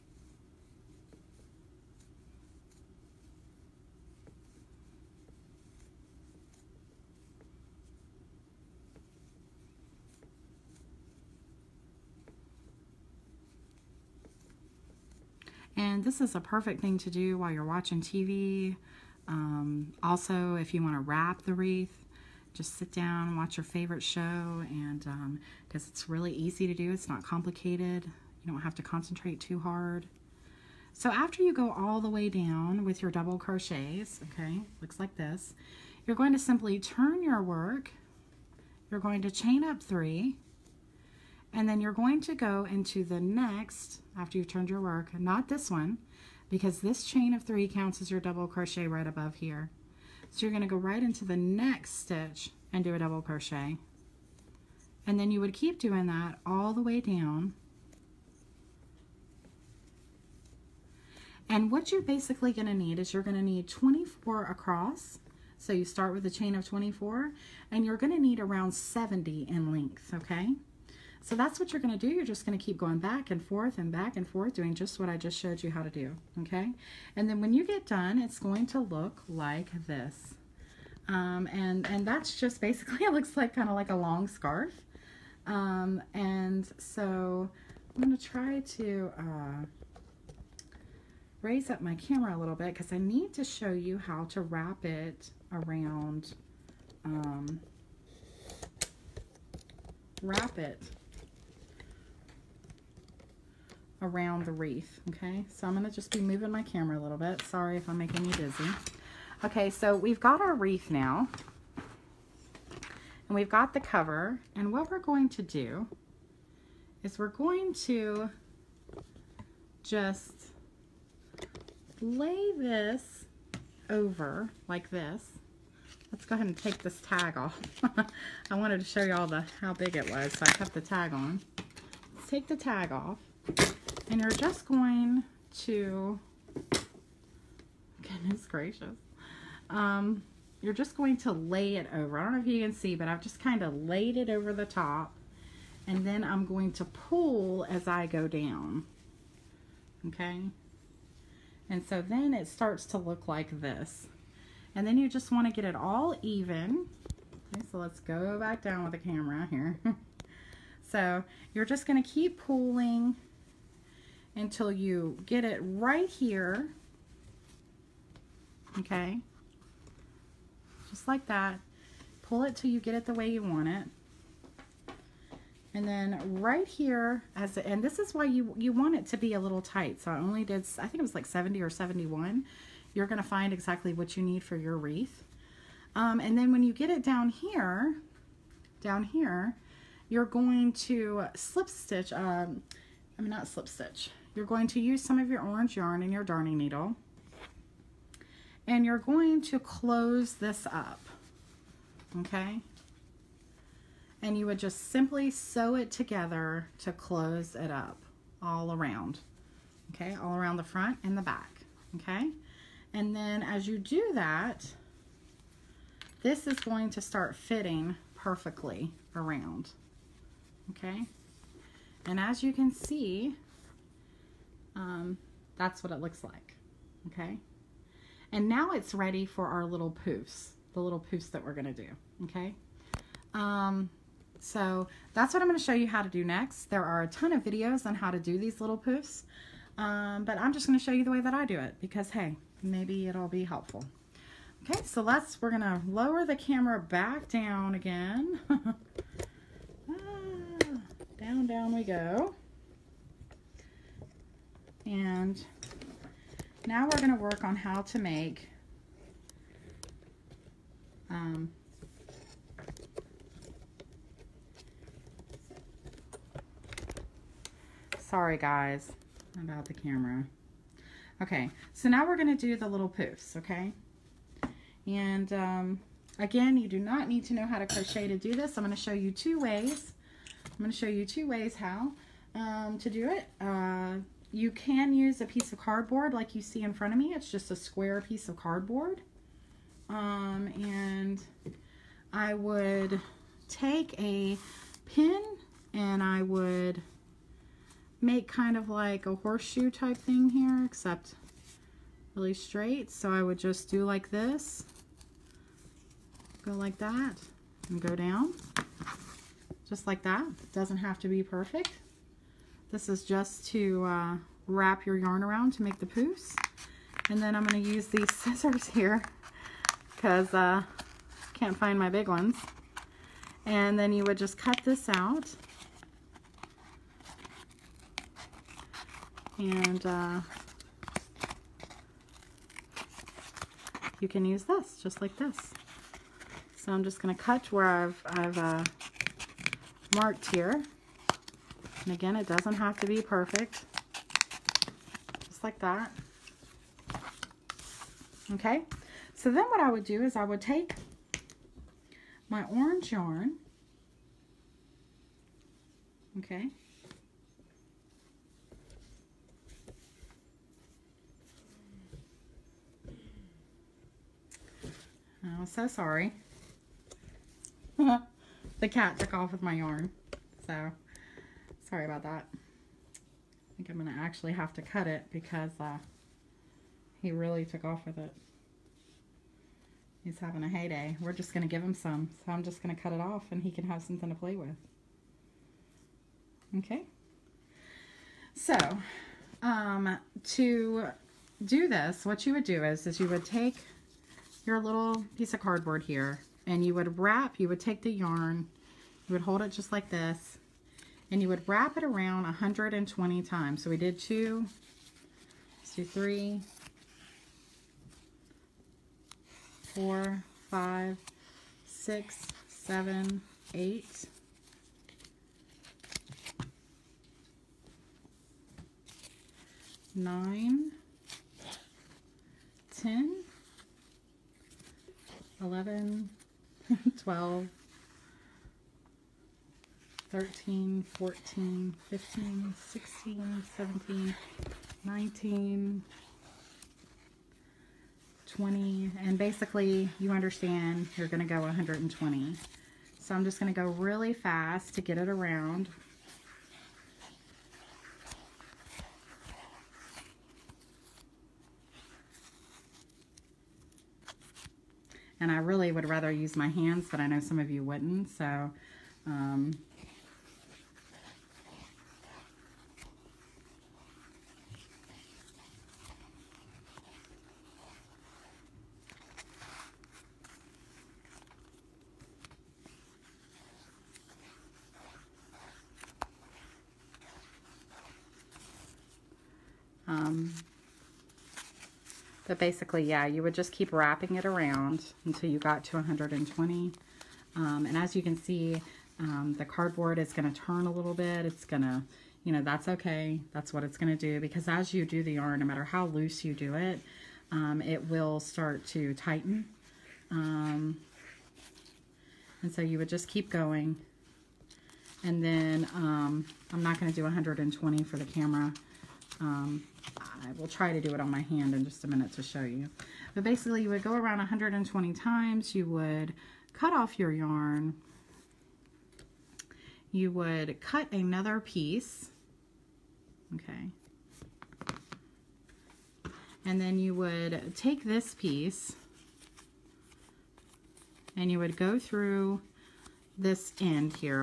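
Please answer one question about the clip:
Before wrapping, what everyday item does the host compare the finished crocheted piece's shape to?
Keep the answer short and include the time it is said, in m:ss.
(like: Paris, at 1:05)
a long scarf, at 1:23.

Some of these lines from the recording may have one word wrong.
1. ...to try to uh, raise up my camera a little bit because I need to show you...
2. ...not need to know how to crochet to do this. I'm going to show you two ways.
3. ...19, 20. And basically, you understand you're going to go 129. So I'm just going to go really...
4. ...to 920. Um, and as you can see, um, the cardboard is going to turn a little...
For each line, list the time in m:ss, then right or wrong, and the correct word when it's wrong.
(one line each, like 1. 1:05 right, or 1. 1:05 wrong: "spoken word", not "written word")
1. 1:28 right
2. 4:36 right
3. 7:14 wrong: "120", not "129"
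4. 8:05 wrong: "120", not "920".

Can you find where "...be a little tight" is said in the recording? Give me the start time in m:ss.
2:59.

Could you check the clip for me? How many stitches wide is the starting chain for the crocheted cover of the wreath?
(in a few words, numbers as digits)
24.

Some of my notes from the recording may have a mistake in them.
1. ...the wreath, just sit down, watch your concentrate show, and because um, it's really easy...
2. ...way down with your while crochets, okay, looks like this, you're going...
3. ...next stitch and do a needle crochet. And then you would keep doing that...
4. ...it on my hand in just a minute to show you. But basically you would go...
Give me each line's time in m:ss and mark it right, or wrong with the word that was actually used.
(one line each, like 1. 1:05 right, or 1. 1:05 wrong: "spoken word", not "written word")
1. 0:21 wrong: "favorite", not "concentrate"
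2. 0:32 wrong: "double", not "while"
3. 0:51 wrong: "double", not "needle"
4. 8:30 right.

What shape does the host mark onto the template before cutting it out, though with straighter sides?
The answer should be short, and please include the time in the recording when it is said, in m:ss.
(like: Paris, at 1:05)
horseshoe, at 4:59.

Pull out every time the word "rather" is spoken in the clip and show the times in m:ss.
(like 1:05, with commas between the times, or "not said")
7:35.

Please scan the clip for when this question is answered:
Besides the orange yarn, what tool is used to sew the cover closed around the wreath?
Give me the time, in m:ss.
3:16.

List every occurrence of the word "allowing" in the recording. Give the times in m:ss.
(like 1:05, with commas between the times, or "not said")
not said.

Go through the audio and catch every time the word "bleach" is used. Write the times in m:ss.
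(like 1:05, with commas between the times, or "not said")
not said.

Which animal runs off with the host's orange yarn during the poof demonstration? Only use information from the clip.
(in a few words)
the cat.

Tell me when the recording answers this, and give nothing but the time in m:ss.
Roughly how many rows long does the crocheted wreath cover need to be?
1:08.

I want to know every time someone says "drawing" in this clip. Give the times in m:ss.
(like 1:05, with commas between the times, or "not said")
not said.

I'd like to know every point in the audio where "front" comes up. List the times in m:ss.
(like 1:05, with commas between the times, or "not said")
3:30, 4:46.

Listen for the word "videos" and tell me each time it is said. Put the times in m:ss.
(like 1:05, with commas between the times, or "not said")
3:57.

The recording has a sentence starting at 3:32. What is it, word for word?
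And then as you do that, this is going to start fitting perfectly around, okay?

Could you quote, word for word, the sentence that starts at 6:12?
I think I'm going to actually have to cut it because uh, he really took off with it.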